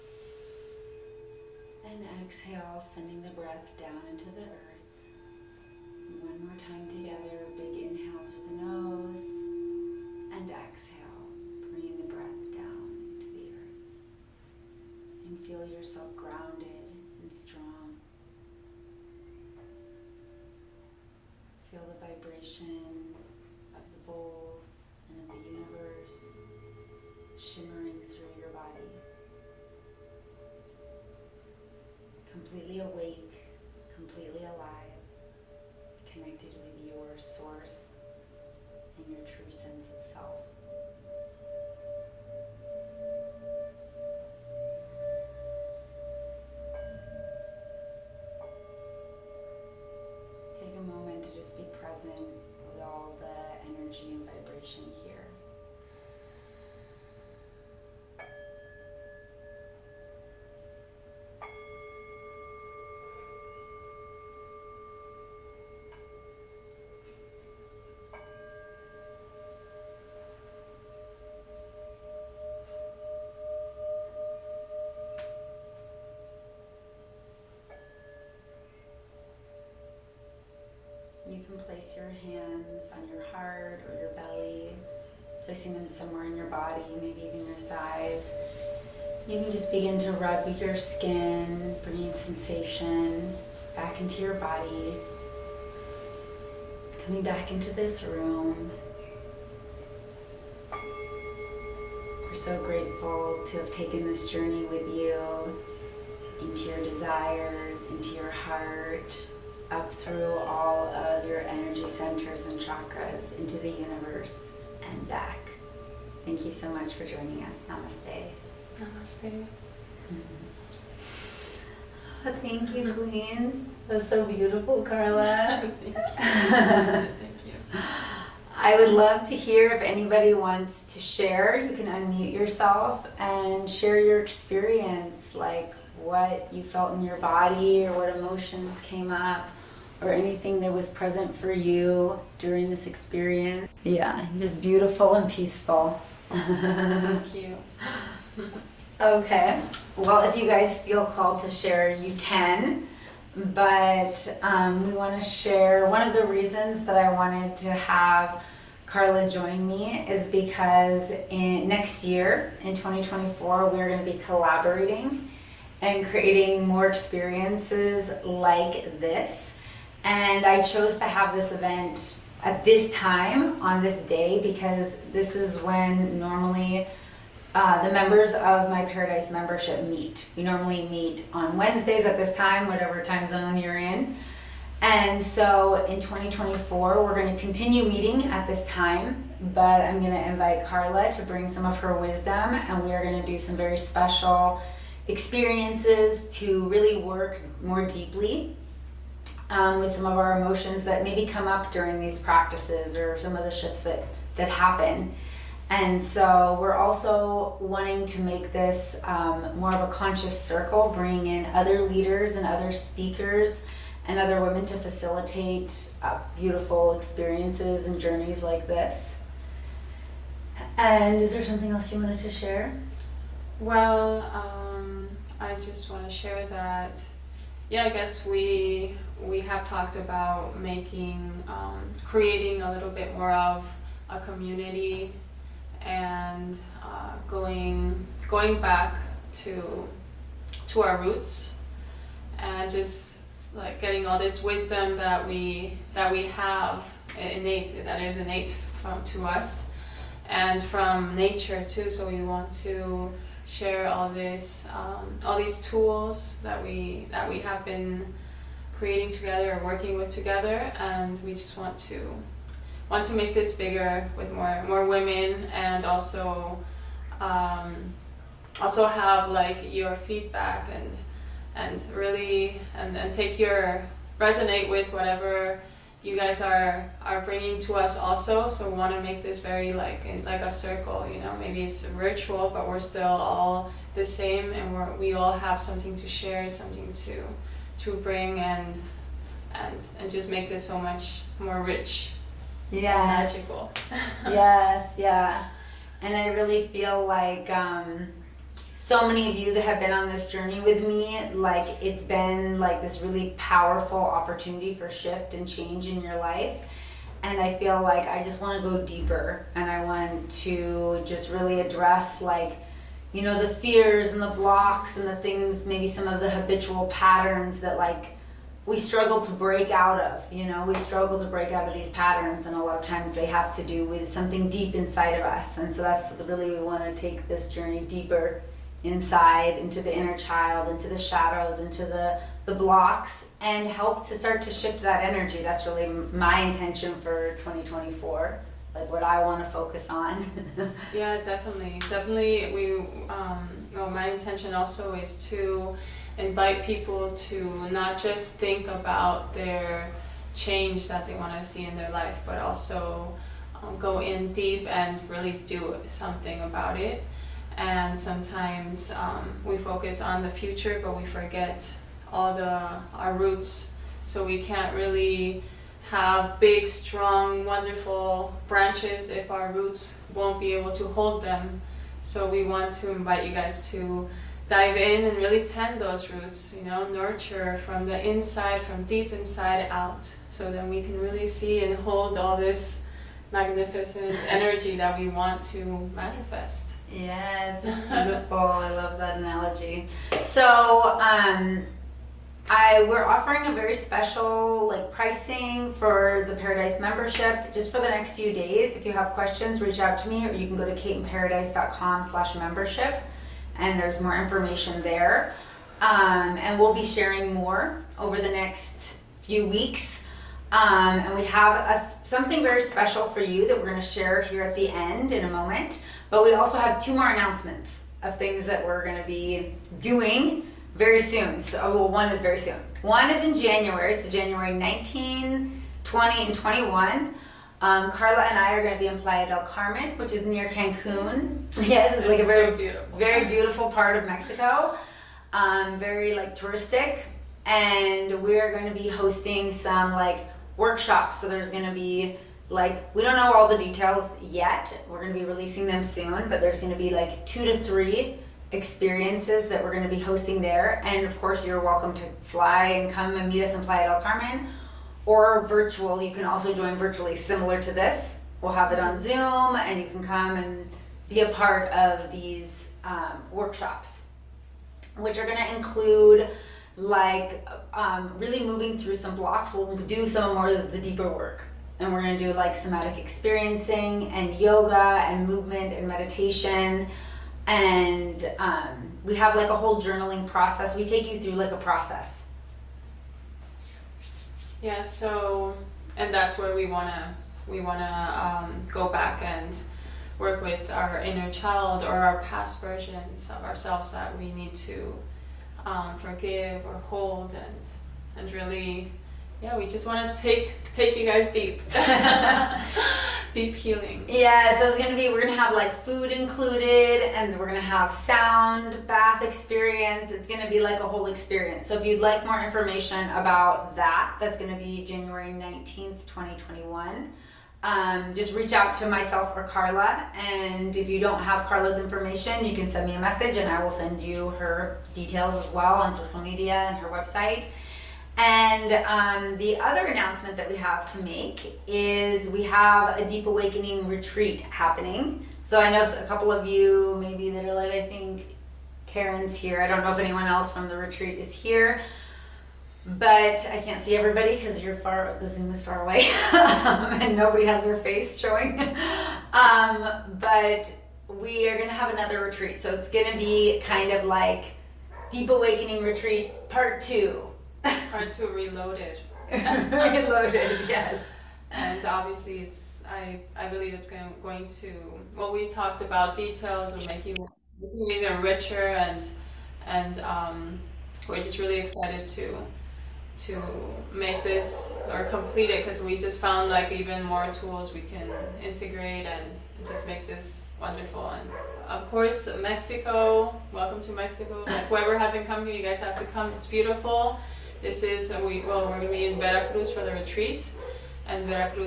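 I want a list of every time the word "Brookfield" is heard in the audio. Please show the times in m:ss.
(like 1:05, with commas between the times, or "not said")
not said.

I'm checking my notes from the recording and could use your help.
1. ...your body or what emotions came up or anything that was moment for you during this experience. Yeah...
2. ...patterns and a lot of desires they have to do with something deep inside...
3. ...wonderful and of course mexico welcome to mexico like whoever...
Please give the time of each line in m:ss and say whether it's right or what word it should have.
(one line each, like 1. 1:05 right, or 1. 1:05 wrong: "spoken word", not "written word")
1. 2:17 wrong: "present", not "moment"
2. 5:21 wrong: "times", not "desires"
3. 9:40 right.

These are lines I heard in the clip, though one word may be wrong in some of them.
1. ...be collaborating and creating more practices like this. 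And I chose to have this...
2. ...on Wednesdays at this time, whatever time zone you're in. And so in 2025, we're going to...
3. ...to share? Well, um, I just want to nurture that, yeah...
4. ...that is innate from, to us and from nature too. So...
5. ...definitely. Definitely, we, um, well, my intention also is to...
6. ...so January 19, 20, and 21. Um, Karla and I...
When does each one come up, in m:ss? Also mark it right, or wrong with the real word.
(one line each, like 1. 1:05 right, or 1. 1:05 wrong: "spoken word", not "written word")
1. 2:44 wrong: "experiences", not "practices"
2. 3:01 wrong: "2024", not "2025"
3. 3:42 wrong: "share", not "nurture"
4. 4:07 right
5. 5:41 right
6. 7:03 right.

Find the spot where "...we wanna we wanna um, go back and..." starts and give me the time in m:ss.
8:06.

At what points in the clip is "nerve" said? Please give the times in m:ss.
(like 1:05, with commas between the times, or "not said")
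not said.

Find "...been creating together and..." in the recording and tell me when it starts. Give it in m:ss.
4:17.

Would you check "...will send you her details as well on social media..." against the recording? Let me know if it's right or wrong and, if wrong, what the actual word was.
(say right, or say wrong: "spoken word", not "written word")
right.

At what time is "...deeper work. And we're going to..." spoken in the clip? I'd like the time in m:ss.
7:50.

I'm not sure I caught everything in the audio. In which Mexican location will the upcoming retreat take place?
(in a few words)
Veracruz.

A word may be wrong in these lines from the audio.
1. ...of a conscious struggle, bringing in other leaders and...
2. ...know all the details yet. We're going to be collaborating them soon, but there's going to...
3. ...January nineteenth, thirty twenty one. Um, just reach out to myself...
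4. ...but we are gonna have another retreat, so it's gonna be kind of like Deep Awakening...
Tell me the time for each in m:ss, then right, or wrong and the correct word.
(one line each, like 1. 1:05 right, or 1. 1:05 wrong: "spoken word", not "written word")
1. 3:29 wrong: "circle", not "struggle"
2. 7:23 wrong: "releasing", not "collaborating"
3. 8:34 wrong: "twenty", not "thirty"
4. 9:10 right.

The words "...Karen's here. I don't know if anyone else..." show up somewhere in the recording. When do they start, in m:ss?
8:58.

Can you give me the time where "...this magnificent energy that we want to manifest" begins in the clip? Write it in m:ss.
6:22.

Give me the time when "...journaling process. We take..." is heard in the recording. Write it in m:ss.
7:59.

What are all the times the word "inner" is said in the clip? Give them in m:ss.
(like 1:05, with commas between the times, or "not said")
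5:29, 8:11.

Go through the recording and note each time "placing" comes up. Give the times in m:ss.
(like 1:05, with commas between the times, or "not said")
1:25.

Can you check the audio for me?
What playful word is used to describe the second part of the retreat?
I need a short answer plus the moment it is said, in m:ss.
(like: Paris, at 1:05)
Reloaded, at 9:19.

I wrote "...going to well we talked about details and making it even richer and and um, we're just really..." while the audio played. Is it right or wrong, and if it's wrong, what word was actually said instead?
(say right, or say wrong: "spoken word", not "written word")
right.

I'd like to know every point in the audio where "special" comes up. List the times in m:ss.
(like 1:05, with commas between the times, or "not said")
3:13, 6:33, 6:52.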